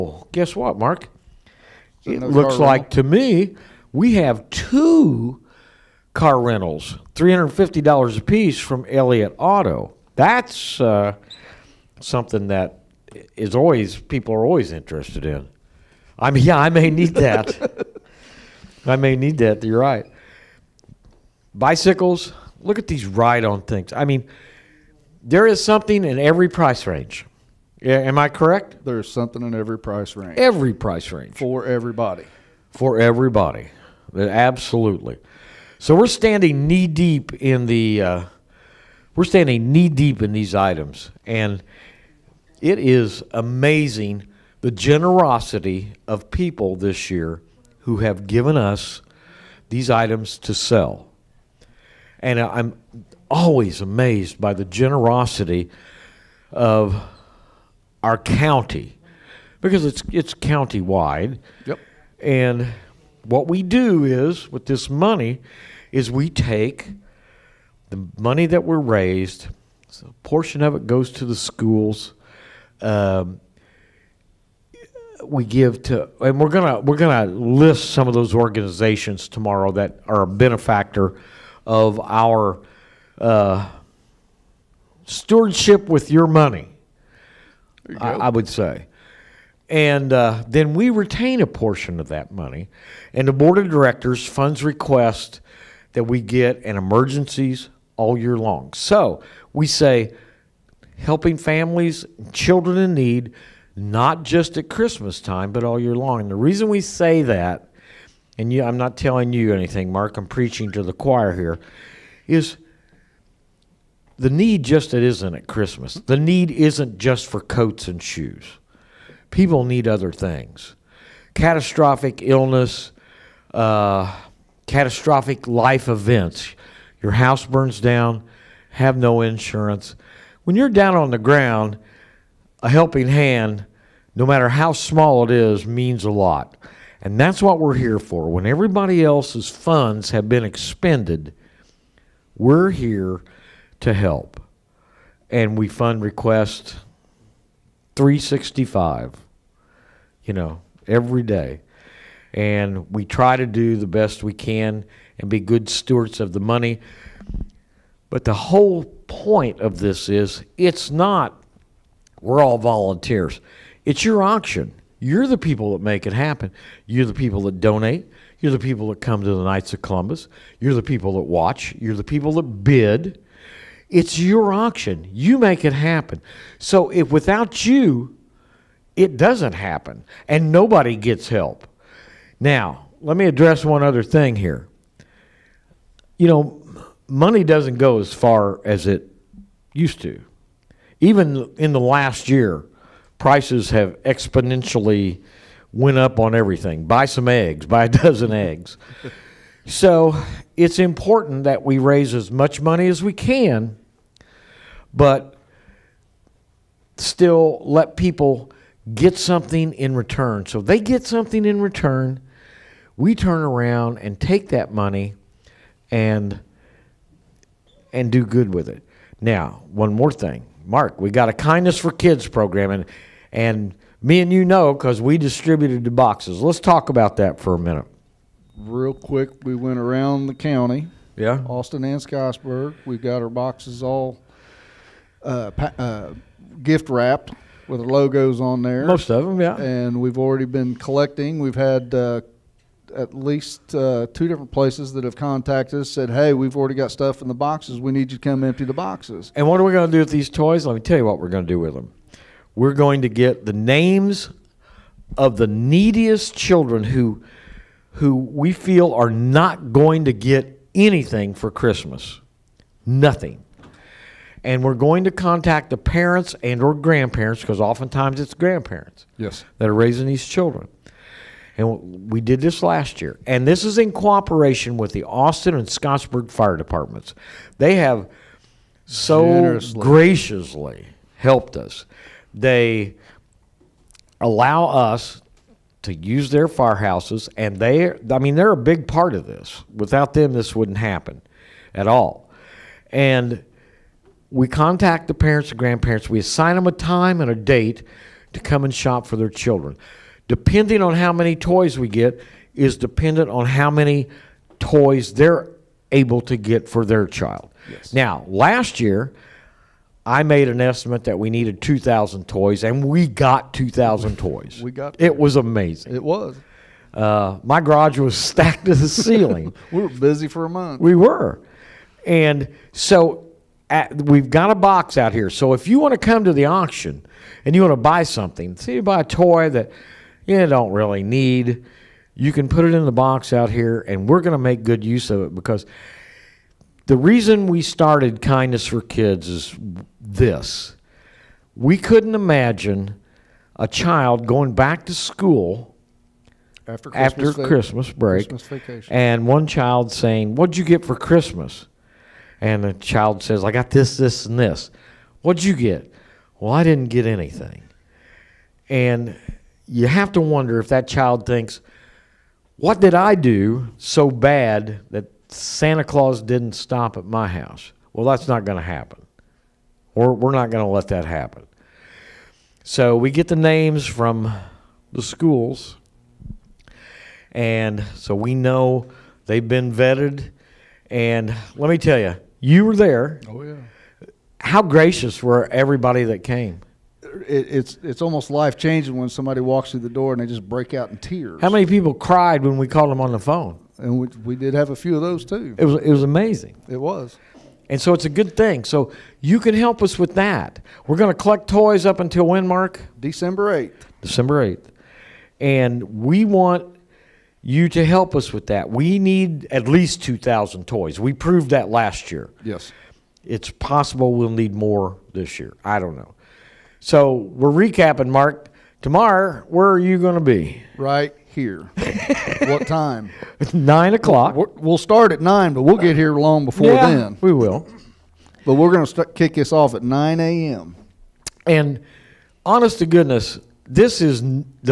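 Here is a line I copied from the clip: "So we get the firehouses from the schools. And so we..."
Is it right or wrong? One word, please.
wrong.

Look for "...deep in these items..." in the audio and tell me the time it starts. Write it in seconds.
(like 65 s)
39 s.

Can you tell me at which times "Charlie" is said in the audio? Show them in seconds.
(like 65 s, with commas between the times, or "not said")
not said.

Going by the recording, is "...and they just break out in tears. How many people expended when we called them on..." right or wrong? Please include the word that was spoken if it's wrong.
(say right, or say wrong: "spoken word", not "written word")
wrong: "cried", not "expended".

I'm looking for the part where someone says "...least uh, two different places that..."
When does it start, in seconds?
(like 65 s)
243 s.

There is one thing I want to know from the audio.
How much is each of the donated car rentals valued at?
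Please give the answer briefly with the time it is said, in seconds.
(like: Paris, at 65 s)
$350, at 7 s.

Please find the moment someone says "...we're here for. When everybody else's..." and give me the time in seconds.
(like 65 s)
137 s.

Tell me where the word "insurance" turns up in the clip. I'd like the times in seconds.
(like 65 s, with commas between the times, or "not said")
129 s.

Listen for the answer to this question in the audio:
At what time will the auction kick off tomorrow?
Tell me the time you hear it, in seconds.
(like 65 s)
429 s.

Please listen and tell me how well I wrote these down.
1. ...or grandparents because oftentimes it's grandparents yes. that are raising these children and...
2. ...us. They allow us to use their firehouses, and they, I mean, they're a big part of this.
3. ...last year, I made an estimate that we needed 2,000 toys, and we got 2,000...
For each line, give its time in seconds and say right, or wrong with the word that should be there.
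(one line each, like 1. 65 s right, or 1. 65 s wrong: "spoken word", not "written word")
1. 266 s right
2. 281 s right
3. 308 s right.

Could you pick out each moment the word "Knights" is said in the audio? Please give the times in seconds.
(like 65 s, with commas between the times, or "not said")
169 s.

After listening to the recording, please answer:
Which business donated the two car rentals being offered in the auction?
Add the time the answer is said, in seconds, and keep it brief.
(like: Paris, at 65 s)
Elliott Auto, at 8 s.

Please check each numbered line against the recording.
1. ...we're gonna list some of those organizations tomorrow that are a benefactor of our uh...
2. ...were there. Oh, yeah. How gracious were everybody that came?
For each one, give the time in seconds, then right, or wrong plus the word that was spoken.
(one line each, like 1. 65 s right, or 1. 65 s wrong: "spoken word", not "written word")
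1. 76 s right
2. 382 s right.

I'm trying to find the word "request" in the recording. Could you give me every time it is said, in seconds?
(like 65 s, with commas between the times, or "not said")
94 s, 146 s.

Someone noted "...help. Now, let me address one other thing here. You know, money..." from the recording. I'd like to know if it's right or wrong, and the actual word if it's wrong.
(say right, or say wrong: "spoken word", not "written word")
right.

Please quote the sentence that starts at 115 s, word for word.
The need isn't just for coats and shoes.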